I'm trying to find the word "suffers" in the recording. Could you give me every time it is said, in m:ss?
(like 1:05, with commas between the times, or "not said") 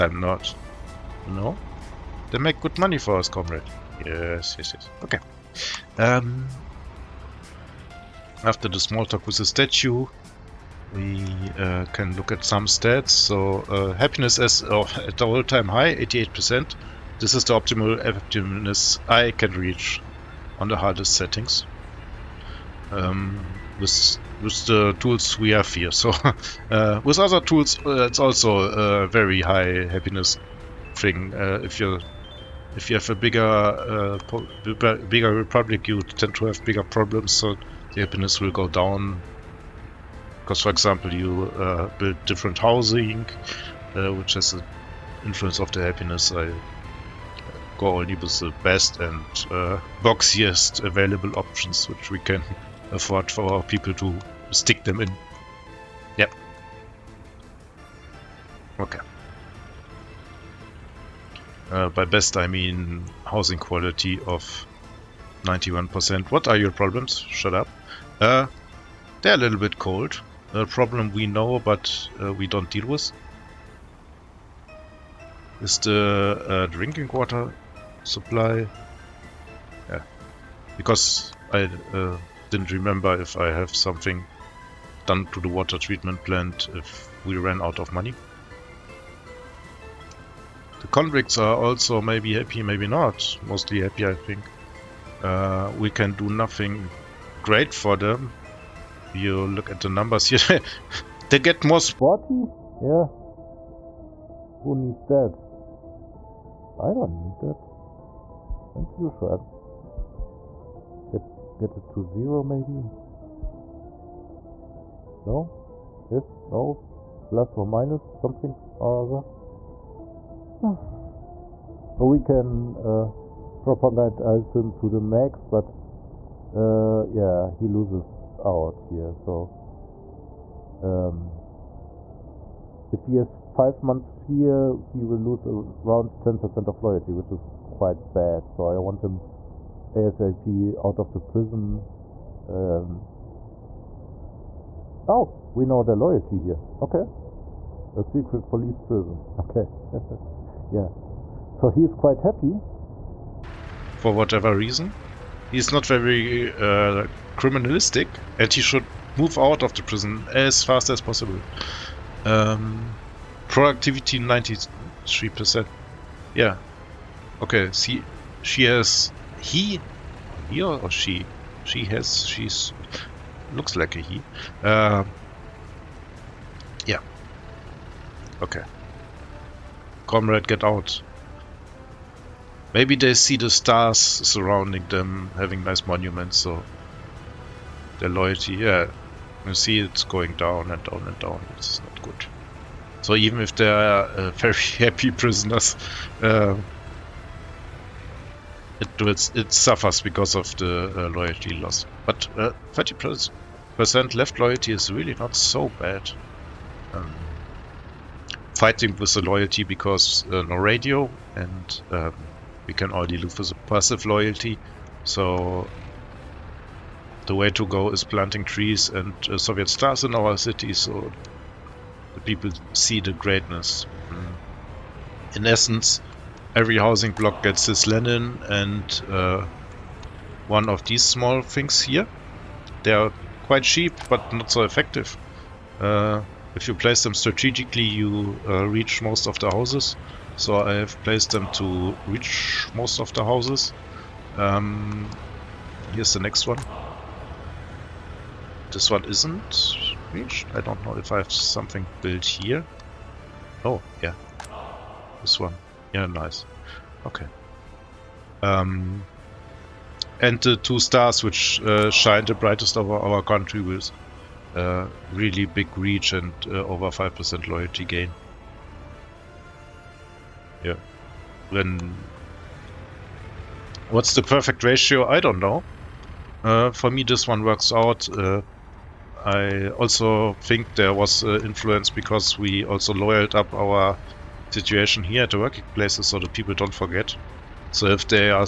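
3:19.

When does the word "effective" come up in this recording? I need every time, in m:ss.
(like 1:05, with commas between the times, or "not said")
3:54.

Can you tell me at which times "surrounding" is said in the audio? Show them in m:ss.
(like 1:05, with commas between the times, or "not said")
3:03.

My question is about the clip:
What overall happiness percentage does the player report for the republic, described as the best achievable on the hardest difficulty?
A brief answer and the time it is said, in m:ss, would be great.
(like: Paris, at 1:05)
88%, at 0:15.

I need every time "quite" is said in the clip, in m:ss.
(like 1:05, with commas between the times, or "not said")
2:17, 2:31, 3:53.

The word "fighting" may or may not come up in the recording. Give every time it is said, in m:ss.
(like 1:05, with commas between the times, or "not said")
3:28.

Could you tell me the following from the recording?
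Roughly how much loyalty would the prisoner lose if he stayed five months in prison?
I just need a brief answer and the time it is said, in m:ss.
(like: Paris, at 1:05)
10%, at 2:16.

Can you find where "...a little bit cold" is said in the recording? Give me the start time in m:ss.
1:09.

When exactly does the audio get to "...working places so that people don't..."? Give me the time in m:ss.
4:45.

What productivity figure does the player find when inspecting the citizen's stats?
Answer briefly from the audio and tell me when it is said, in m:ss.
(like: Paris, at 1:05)
93%, at 2:44.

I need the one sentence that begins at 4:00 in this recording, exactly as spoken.
So I have placed them to reach most of the houses.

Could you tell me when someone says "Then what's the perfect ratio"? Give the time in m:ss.
4:31.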